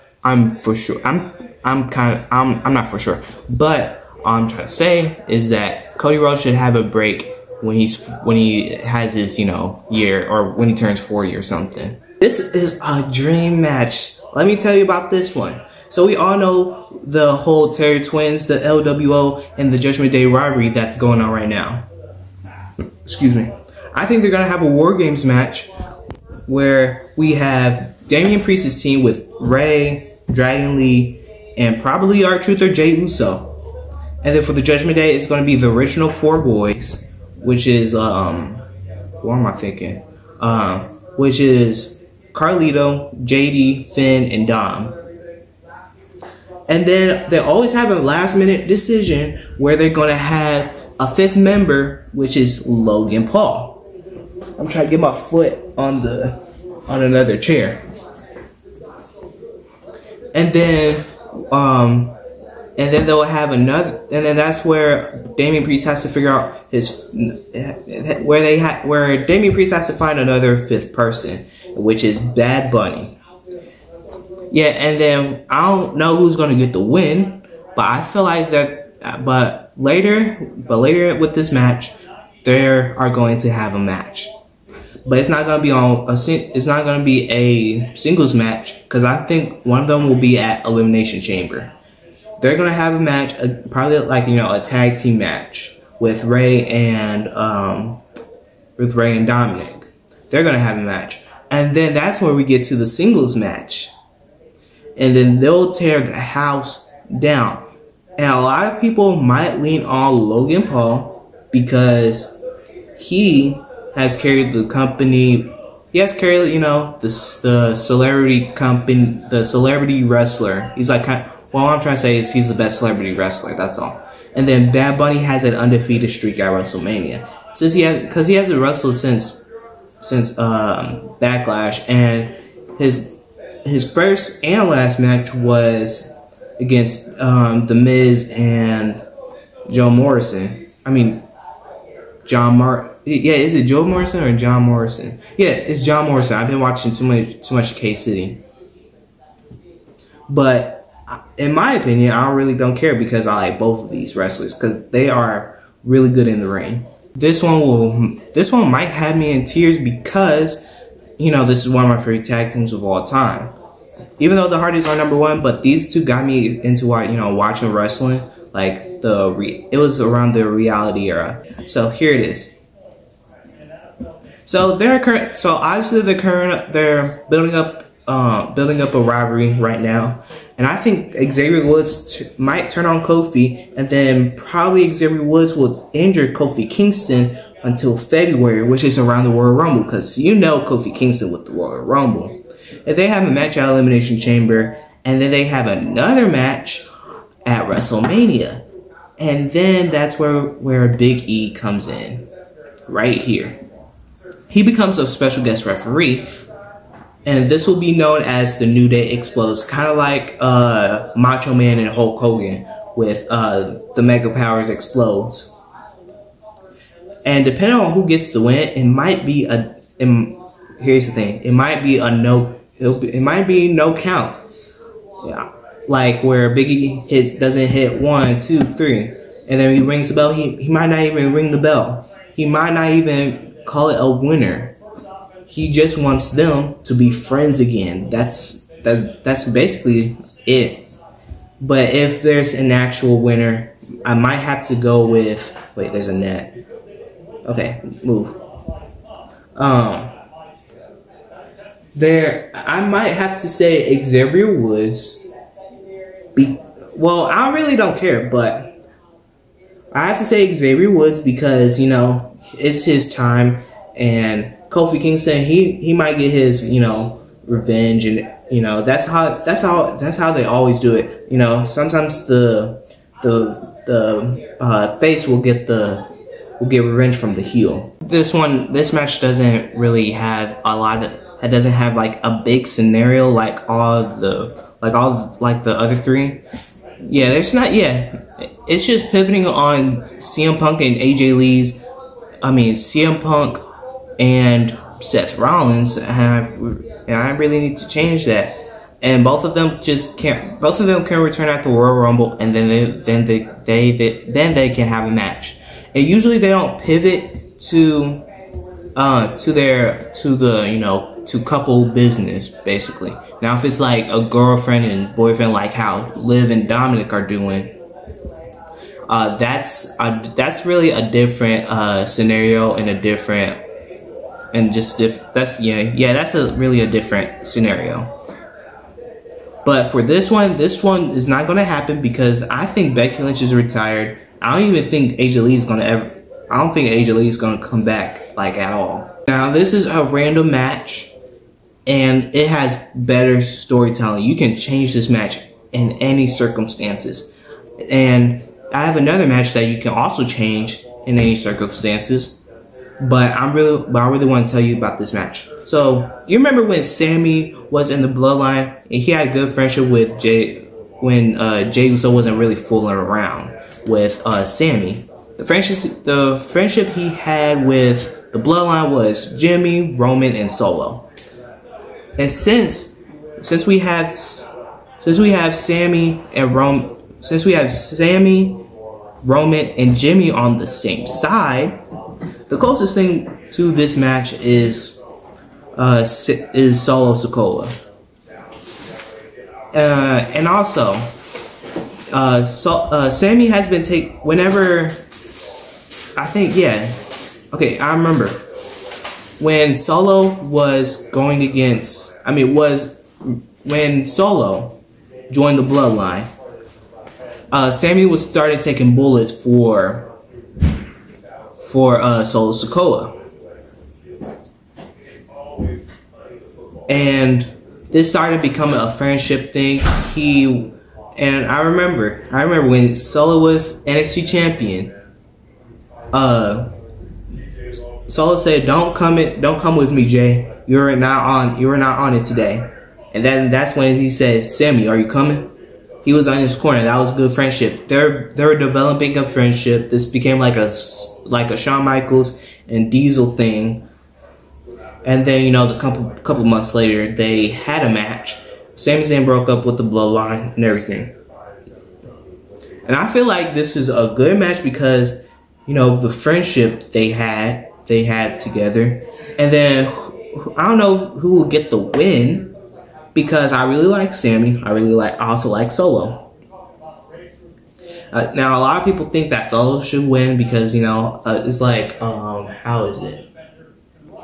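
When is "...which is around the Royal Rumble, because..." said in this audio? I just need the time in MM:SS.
03:08.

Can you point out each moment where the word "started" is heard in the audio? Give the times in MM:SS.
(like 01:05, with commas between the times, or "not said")
06:48, 06:58.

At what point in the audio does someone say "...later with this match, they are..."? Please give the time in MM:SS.
01:20.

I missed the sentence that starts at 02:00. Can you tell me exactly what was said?
He's like kind of, well, I'm trying to say is he's the best celebrity wrestler.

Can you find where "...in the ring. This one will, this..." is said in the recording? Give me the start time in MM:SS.
02:36.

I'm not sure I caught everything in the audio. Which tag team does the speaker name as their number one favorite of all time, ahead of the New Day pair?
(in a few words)
The Hardys.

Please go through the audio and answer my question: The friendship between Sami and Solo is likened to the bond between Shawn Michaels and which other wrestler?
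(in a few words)
Diesel.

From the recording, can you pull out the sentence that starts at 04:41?
It doesn't have like a big scenario like all the like all like the other three.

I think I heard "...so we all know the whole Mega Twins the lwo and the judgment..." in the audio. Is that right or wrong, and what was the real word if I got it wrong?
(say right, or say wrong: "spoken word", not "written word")
wrong: "Terror", not "Mega".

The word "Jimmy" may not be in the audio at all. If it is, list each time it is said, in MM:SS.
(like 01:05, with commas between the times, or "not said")
06:09, 06:19.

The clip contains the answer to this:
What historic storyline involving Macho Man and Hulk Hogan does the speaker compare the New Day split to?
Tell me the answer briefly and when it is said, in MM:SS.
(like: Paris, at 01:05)
The Mega Powers Explodes, at 03:33.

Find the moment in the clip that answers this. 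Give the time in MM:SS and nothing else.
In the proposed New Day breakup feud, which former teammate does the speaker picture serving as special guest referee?
03:20.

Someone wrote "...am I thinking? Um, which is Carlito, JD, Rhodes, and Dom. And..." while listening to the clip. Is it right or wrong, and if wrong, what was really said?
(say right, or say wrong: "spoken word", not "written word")
wrong: "Finn", not "Rhodes".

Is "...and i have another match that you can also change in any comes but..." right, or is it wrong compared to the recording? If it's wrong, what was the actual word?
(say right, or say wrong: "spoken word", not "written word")
wrong: "circumstances", not "comes".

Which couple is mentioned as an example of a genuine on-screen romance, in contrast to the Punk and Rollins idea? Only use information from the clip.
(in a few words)
Liv and Dominik.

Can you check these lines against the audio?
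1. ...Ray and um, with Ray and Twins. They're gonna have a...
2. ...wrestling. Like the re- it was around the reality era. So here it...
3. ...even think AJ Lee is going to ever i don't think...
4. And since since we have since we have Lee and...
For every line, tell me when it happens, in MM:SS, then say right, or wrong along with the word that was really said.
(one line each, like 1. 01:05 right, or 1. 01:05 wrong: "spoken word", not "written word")
1. 01:36 wrong: "Dominik", not "Twins"
2. 02:47 right
3. 05:34 right
4. 06:12 wrong: "Sami", not "Lee".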